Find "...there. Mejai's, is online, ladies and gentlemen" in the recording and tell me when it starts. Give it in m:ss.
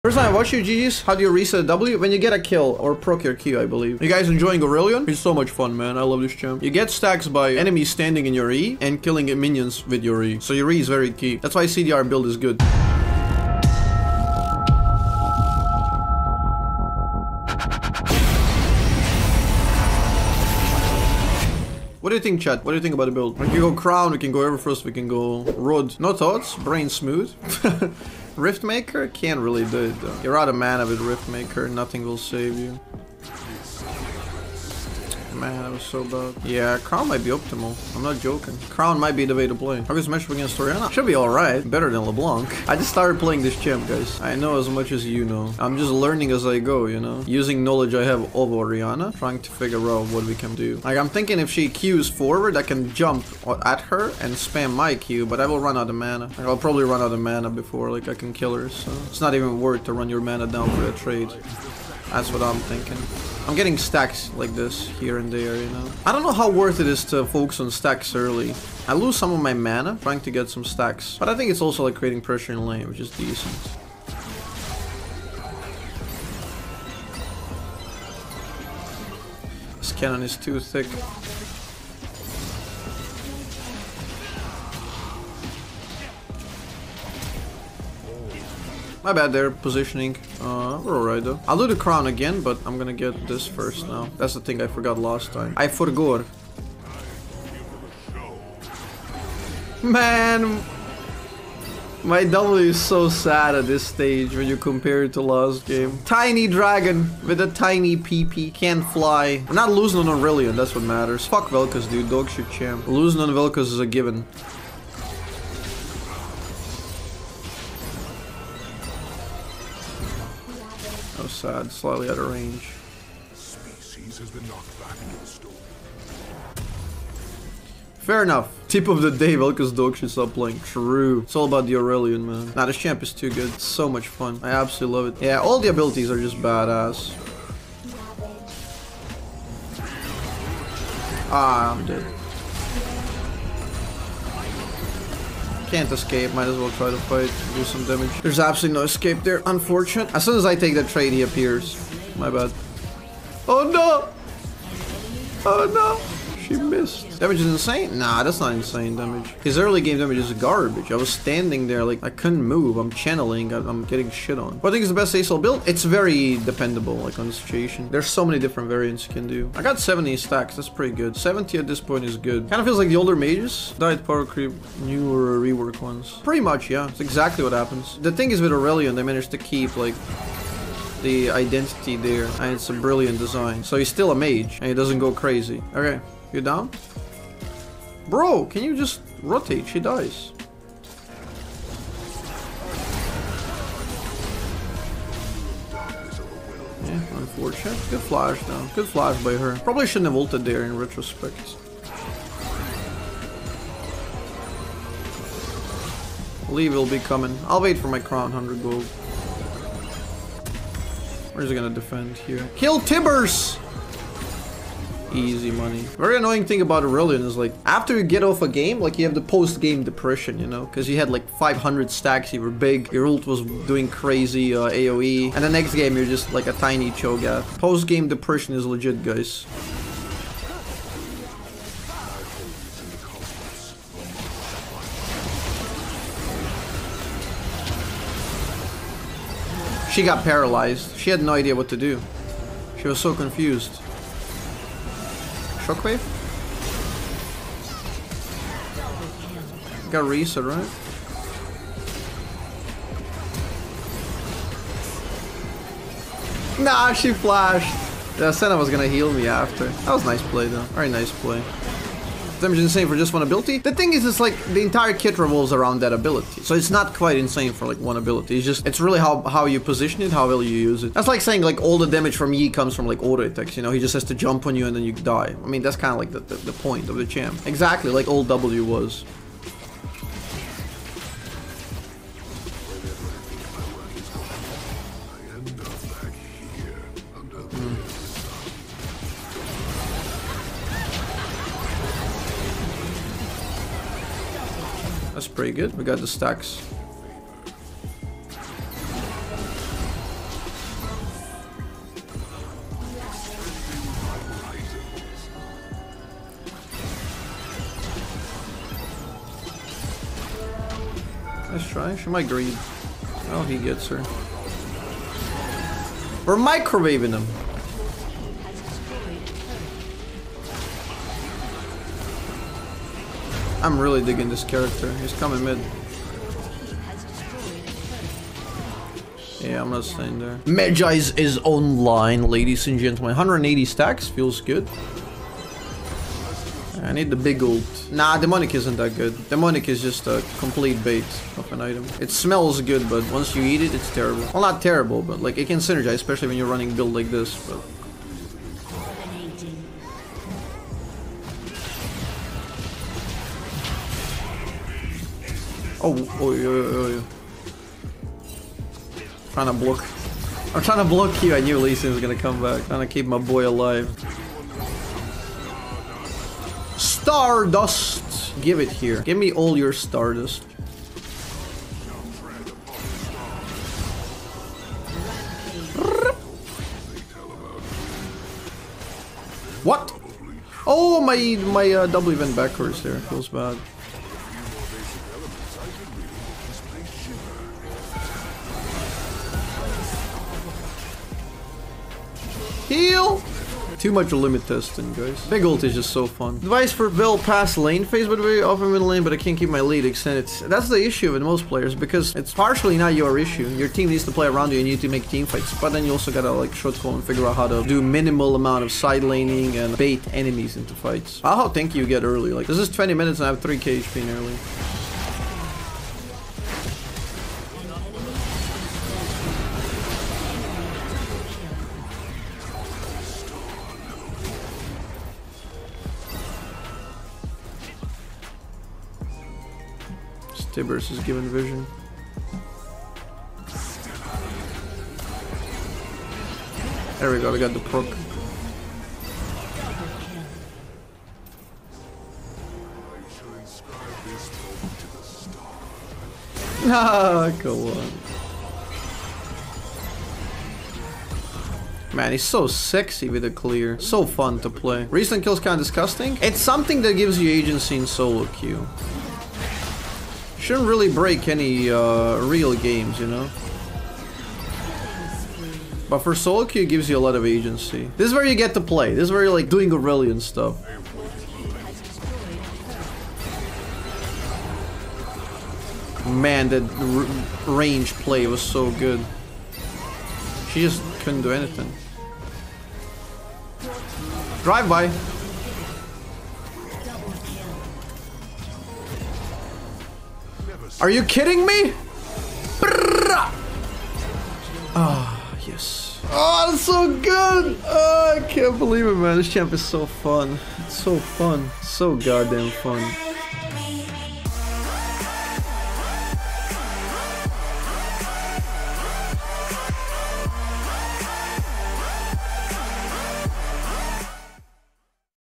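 5:30.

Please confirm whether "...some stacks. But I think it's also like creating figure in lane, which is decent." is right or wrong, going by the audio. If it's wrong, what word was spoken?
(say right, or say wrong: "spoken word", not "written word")
wrong: "pressure", not "figure".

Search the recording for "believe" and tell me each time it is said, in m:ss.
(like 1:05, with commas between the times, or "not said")
0:03, 8:18.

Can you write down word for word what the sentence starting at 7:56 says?
Man, that range play was so good.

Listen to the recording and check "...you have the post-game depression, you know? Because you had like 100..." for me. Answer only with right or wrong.
wrong.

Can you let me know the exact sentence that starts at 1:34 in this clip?
That's the thing I forgot last time.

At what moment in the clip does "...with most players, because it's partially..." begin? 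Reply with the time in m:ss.
6:41.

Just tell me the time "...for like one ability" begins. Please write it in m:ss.
4:27.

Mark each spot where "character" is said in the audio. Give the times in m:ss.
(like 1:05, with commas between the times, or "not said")
5:24.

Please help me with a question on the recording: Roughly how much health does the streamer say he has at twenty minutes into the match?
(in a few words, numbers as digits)
3k HP.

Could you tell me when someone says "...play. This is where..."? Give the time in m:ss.
7:48.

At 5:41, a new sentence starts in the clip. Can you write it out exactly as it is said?
It smells good, but once you eat it, it's terrible.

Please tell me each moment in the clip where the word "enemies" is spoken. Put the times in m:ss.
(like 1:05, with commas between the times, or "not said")
0:07, 6:50.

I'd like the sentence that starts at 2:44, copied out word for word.
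What I think is the best ASL build?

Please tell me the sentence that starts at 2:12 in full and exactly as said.
Nah, this champ is too good.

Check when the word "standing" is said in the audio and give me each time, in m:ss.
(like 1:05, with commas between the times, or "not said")
0:07, 2:41.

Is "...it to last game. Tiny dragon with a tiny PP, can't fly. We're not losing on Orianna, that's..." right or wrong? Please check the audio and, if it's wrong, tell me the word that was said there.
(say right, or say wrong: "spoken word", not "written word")
wrong: "Aurelion", not "Orianna".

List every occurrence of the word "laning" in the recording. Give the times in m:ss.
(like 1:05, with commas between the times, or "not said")
6:49.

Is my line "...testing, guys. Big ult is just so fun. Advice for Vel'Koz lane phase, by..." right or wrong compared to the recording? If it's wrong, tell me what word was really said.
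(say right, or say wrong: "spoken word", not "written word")
right.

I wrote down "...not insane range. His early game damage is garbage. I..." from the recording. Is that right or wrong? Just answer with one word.
wrong.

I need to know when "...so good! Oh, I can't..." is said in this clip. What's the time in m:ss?
8:16.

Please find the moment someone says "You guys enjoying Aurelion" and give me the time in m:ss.
0:04.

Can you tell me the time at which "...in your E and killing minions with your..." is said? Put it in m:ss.
0:08.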